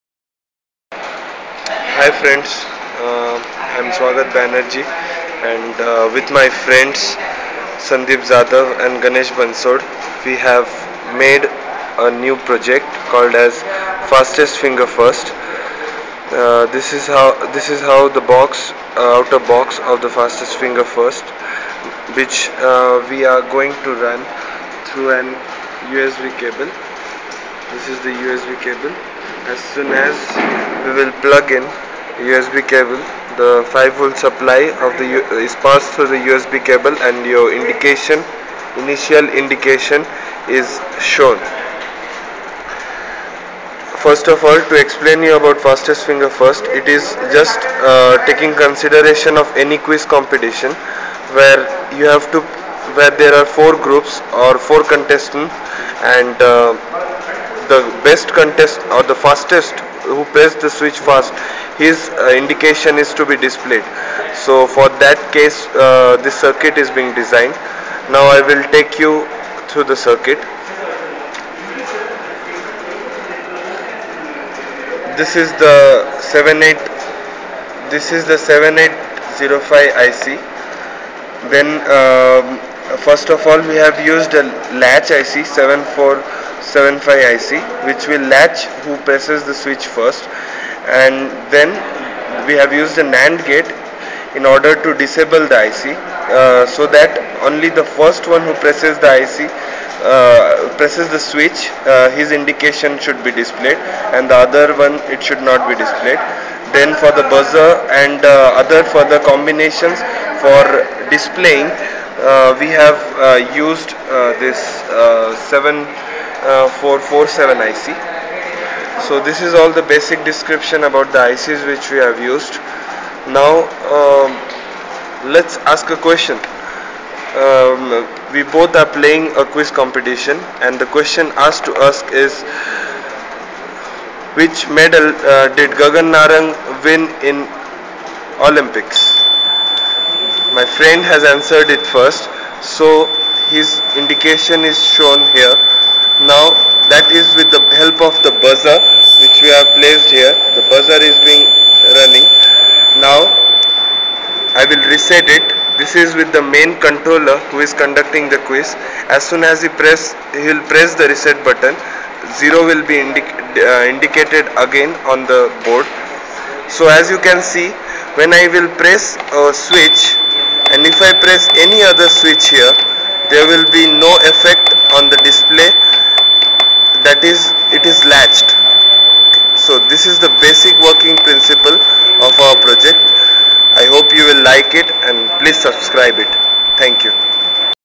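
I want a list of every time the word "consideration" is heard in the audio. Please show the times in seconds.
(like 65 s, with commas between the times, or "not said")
48 s.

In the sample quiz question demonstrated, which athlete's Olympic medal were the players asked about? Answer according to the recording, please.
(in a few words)
Gagan Narang.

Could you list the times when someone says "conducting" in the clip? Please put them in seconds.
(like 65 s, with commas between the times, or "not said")
157 s.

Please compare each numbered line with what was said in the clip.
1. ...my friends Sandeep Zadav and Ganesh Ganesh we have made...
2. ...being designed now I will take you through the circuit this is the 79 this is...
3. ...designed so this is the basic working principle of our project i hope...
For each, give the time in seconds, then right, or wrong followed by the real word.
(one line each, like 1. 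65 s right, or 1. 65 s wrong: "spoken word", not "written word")
1. 6 s wrong: "Bansod", not "Ganesh"
2. 66 s wrong: "78", not "79"
3. 178 s wrong: "latched", not "designed".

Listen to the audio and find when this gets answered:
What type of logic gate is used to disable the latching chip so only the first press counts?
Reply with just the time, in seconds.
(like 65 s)
93 s.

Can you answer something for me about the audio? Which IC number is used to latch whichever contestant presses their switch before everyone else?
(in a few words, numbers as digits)
7475.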